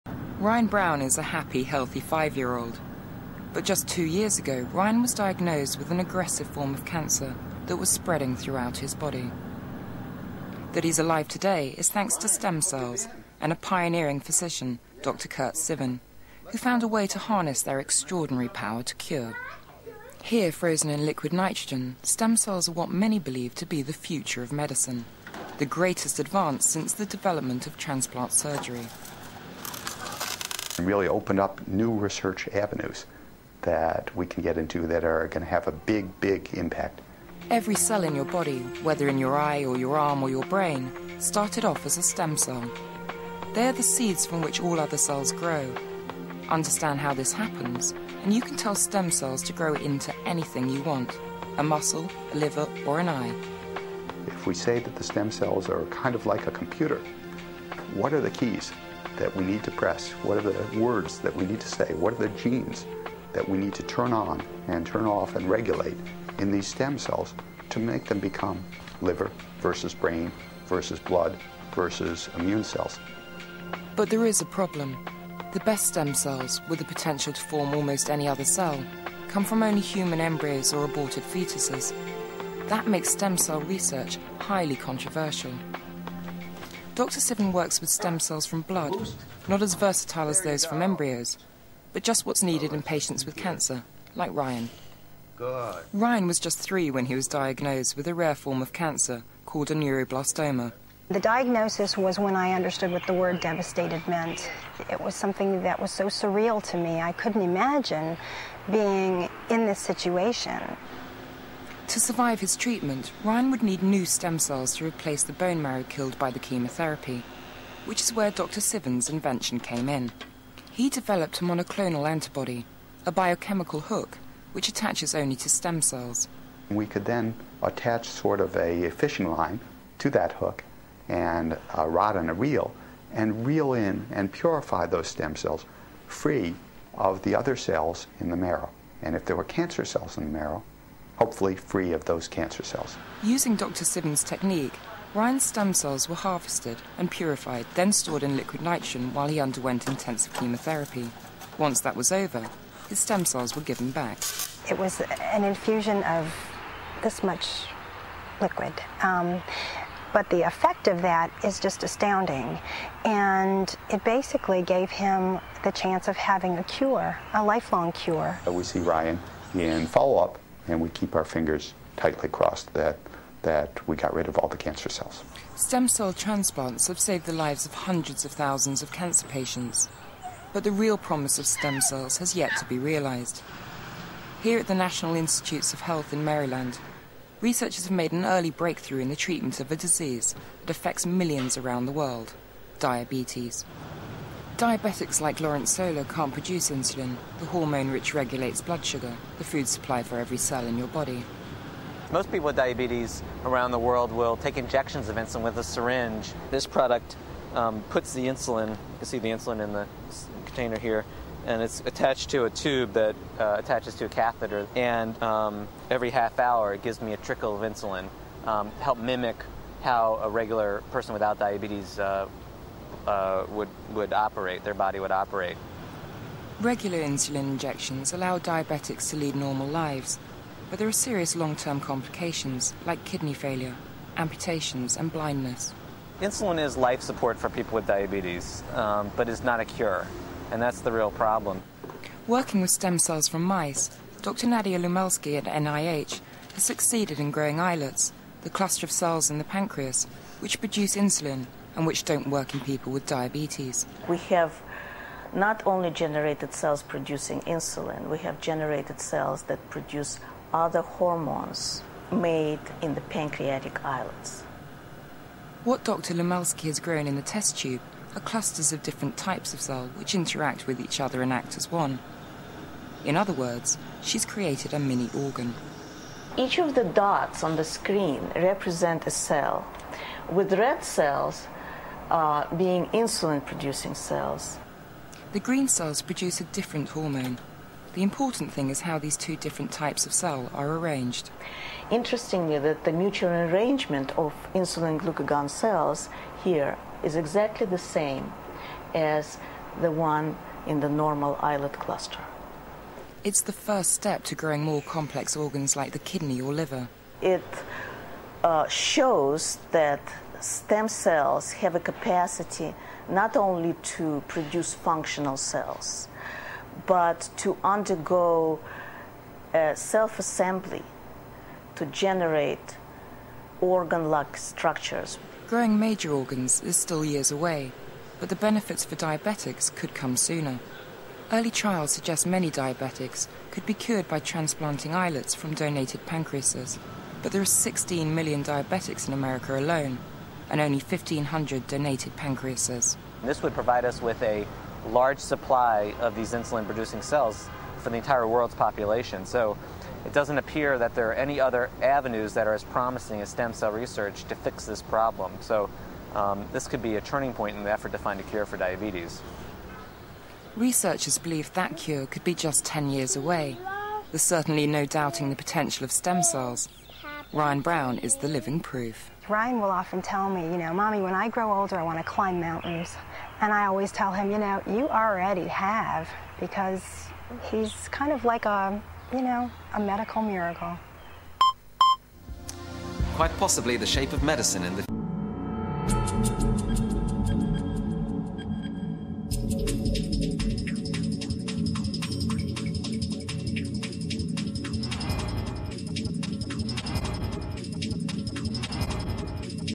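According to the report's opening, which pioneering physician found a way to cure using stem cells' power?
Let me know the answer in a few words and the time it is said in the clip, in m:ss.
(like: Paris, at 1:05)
Curt Civin, at 0:15.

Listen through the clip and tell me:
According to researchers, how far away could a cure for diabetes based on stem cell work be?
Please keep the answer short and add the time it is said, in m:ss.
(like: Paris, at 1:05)
10 years, at 6:02.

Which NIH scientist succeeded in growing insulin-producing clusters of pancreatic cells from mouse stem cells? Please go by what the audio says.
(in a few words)
Nadya Lumelsky.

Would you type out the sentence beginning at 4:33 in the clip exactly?
In other words, she's created a mini organ.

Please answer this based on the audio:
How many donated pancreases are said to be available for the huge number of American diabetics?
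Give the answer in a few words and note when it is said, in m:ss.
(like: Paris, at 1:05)
1,500, at 5:40.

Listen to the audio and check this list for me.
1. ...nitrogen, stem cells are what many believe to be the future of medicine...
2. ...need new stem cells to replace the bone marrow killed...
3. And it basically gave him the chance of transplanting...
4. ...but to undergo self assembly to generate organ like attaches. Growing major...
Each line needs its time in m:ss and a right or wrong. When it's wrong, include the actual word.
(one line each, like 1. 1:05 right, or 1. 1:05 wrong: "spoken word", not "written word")
1. 0:21 right
2. 1:53 right
3. 2:43 wrong: "having", not "transplanting"
4. 5:16 wrong: "structures", not "attaches".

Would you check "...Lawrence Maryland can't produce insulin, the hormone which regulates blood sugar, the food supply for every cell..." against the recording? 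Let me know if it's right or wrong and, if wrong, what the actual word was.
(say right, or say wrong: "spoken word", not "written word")
wrong: "Solo", not "Maryland".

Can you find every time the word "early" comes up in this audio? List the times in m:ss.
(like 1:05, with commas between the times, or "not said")
3:08, 5:31.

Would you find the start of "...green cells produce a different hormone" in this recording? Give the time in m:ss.
4:45.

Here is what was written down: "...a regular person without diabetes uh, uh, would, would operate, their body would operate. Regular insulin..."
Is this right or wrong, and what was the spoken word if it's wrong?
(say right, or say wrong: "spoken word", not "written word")
right.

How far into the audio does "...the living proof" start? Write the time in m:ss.
6:08.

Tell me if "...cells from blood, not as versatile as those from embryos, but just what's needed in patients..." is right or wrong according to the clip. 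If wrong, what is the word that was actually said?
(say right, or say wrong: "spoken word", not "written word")
right.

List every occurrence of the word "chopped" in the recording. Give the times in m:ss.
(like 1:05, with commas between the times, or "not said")
not said.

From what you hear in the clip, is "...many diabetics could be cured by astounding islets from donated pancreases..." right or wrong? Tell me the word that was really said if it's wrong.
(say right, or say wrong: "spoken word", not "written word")
wrong: "transplanting", not "astounding".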